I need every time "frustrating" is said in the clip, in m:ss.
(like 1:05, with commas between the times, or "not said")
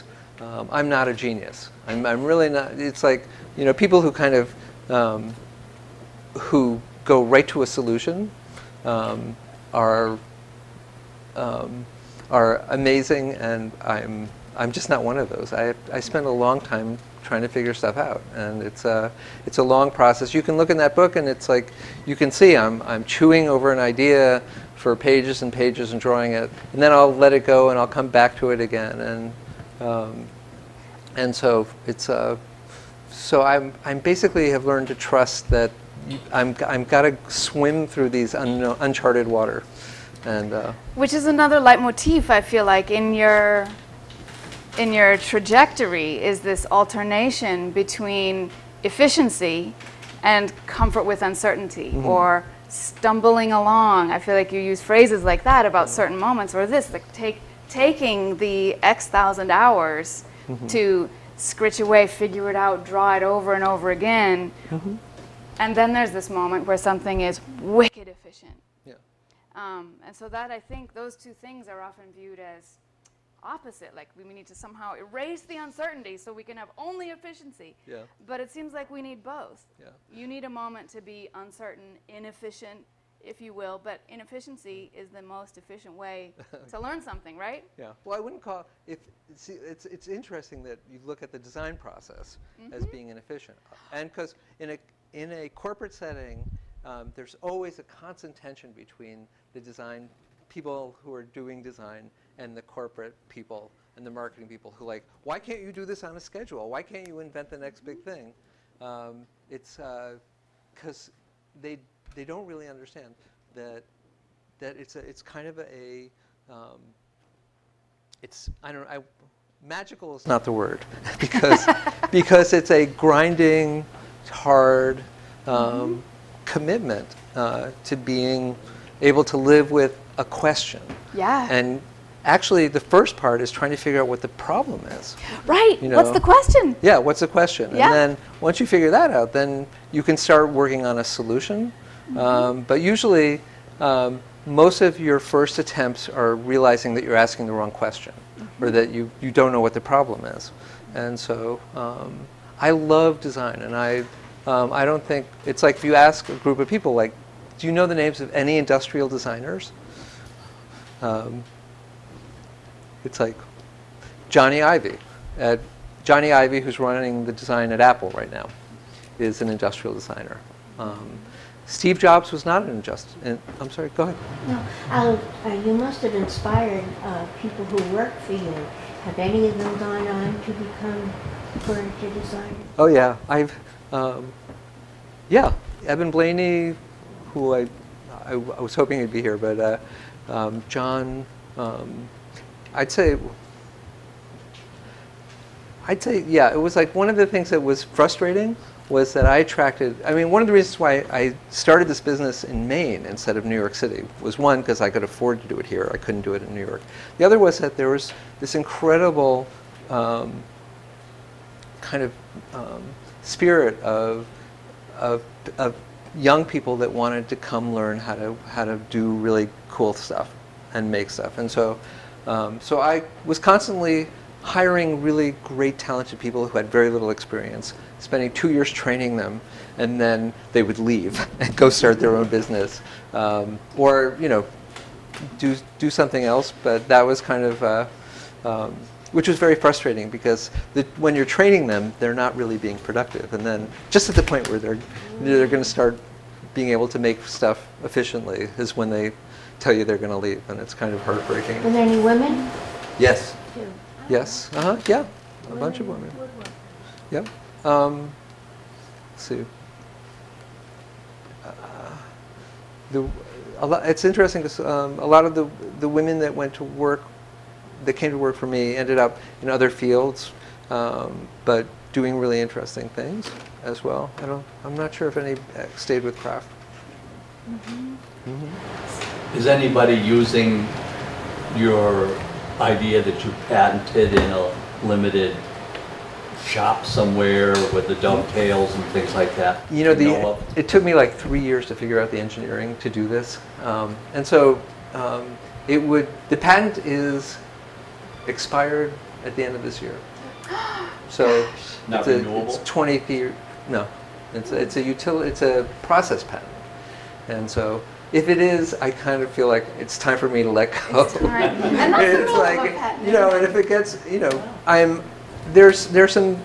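3:17, 3:59.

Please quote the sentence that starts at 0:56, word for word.
certain moments or this, like take, taking the X thousand hours mm -hmm.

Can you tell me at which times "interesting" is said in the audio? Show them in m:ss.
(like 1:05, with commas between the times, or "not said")
1:30, 4:24, 4:32.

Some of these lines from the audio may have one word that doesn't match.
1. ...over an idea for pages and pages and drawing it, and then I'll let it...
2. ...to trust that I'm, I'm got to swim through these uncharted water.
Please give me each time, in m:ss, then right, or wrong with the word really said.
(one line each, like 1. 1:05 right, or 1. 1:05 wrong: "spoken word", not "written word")
1. 0:23 right
2. 0:34 right.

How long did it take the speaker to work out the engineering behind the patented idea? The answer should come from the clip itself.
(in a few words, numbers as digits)
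3 years.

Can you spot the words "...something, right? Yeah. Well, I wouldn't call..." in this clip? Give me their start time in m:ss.
1:27.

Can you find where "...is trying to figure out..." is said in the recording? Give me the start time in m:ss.
2:13.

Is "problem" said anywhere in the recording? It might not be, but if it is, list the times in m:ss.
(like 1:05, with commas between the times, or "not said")
2:14, 2:29.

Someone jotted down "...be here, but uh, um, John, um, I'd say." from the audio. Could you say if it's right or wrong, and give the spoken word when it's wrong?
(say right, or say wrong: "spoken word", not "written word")
right.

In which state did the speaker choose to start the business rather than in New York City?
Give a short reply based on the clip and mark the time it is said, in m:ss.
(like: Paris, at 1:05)
Maine, at 3:22.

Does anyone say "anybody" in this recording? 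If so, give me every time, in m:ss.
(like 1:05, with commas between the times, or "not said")
4:39.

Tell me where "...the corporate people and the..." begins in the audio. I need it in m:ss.
1:42.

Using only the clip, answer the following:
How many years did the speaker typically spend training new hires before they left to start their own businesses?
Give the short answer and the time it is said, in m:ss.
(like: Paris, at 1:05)
2, at 3:48.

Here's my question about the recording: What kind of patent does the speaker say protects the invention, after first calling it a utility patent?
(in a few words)
Process patent.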